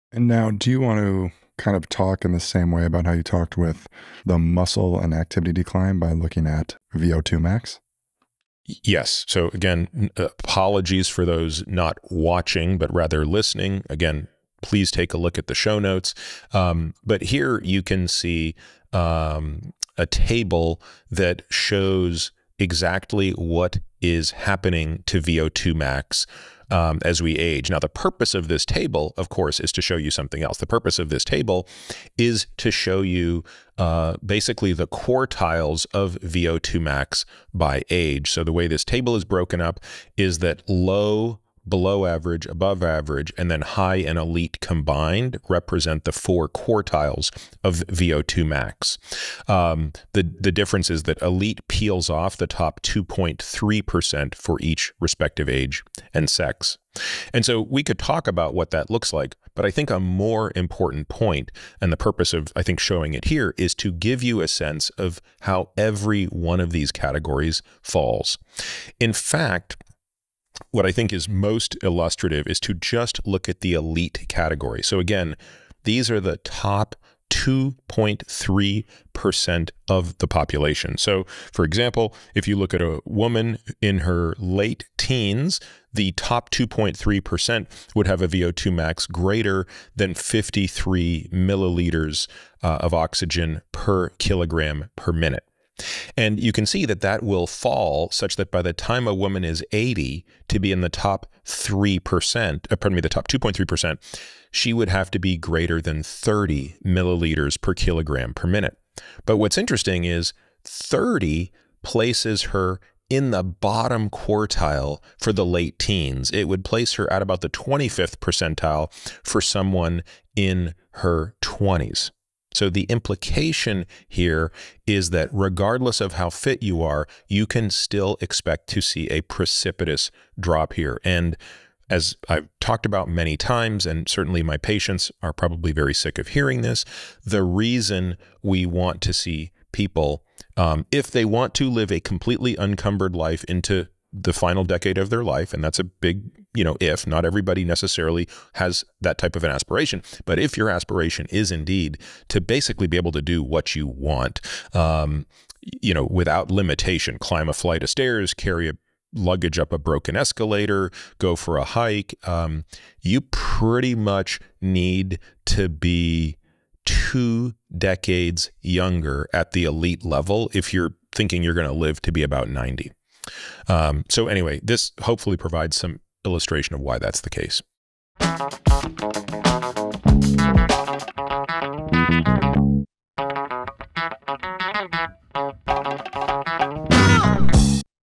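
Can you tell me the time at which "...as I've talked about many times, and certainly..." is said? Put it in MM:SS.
02:11.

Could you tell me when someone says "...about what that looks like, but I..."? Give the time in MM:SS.
00:58.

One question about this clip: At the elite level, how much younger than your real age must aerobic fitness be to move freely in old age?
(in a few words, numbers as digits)
two decades.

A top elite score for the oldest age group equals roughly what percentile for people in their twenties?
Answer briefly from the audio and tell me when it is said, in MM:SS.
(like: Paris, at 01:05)
25th percentile, at 01:57.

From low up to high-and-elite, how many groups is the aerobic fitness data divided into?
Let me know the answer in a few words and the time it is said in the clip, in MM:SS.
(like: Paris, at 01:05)
4 quartiles, at 00:46.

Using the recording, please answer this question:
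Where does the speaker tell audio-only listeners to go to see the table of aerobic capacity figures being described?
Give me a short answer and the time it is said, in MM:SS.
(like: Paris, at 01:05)
show notes, at 00:15.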